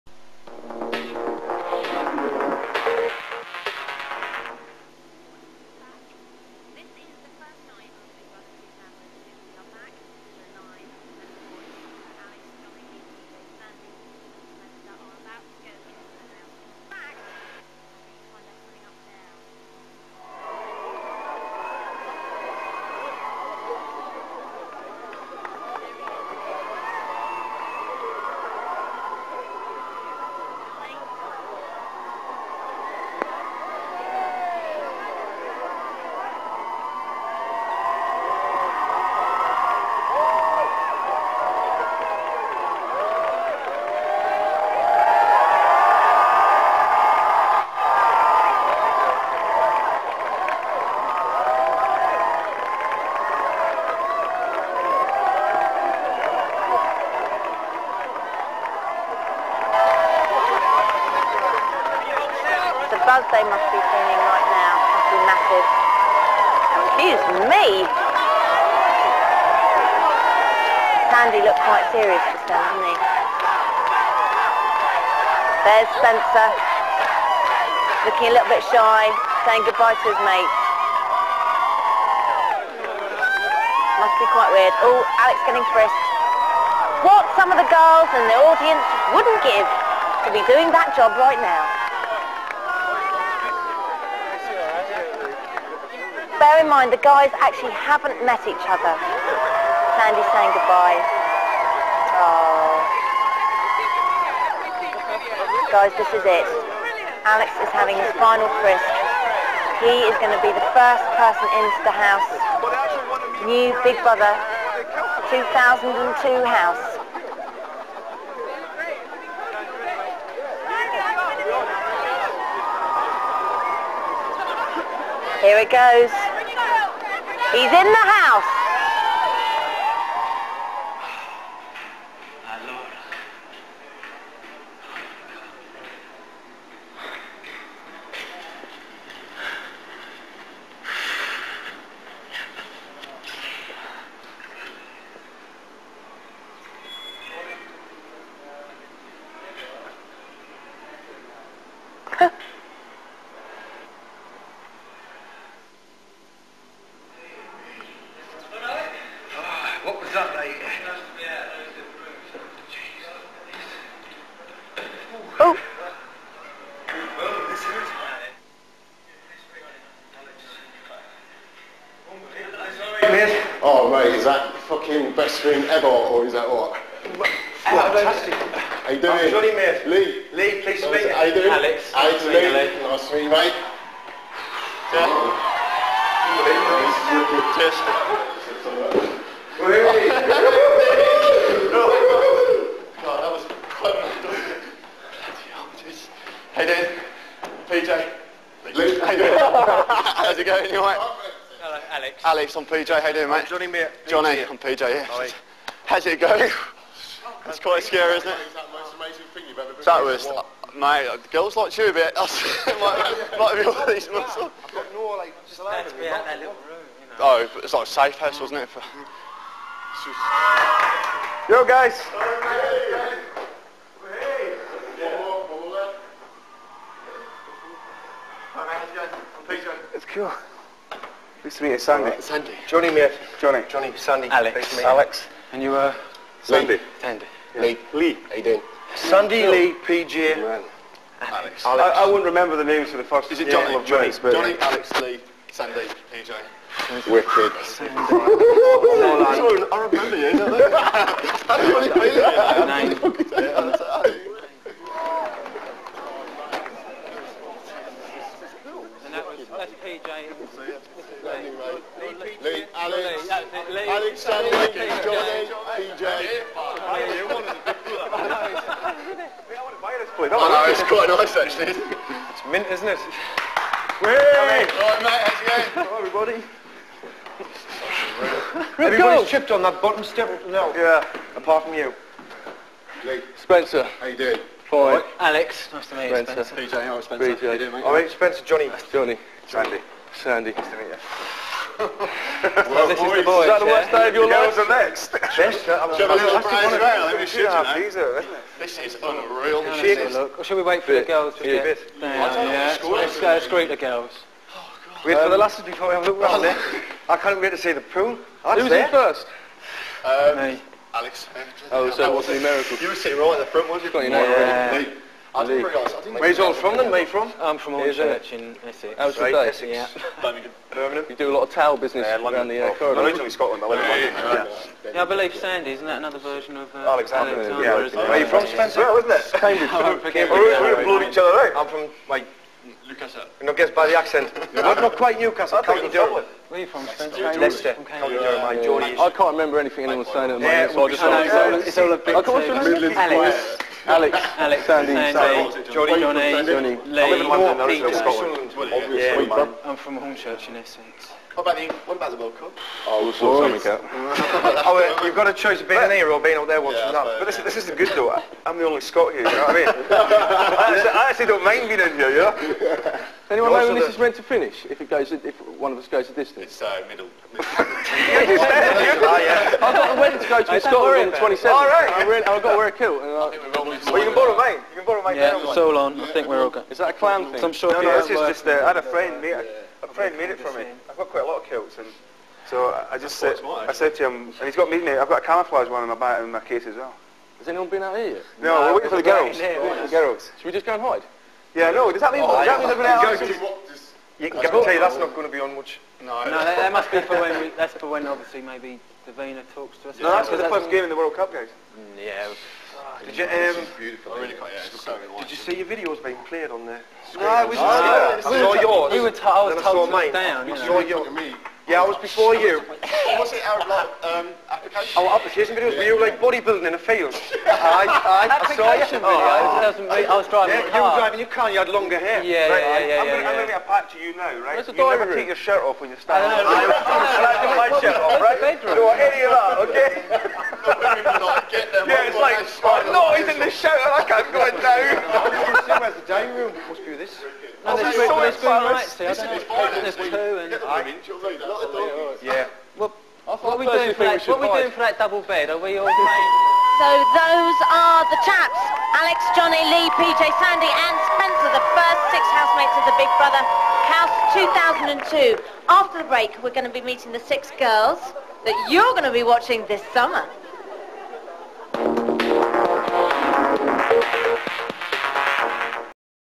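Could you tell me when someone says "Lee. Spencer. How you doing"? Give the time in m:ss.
4:43.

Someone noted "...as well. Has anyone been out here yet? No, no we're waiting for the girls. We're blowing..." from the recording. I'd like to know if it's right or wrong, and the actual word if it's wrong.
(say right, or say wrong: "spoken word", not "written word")
wrong: "waiting", not "blowing".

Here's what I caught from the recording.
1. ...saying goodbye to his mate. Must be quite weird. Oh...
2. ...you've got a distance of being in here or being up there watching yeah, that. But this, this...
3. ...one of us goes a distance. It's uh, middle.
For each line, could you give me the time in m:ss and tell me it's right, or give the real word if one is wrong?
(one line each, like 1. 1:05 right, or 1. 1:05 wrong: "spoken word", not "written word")
1. 1:19 right
2. 5:55 wrong: "choice", not "distance"
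3. 6:05 right.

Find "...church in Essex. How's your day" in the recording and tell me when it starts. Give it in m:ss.
5:17.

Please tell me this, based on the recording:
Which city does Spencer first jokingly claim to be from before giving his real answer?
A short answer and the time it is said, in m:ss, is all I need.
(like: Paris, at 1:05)
Cambridge, at 5:29.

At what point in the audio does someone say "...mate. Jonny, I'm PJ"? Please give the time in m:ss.
3:23.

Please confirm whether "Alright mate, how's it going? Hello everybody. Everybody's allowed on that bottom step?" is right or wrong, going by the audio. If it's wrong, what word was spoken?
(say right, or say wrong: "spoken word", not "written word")
wrong: "chipped", not "allowed".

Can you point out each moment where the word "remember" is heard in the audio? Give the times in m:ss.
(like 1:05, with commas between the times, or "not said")
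4:02, 4:09, 5:39.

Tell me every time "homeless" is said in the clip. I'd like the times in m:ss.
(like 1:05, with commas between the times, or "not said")
not said.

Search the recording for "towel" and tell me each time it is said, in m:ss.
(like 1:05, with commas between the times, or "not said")
5:21.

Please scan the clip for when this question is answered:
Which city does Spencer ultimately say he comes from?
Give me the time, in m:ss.
5:37.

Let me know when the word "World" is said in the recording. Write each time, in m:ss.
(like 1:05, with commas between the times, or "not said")
5:52, 6:40.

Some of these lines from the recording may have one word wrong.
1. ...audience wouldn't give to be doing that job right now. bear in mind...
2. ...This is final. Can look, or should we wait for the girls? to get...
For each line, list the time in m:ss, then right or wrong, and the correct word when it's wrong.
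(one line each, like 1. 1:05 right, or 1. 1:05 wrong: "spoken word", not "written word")
1. 1:28 right
2. 4:58 wrong: "unreal", not "final".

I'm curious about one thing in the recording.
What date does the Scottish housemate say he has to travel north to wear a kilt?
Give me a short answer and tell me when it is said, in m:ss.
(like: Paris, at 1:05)
the 27th, at 6:11.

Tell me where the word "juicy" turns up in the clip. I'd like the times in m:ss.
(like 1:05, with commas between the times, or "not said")
not said.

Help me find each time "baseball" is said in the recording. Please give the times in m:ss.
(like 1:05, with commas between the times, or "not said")
not said.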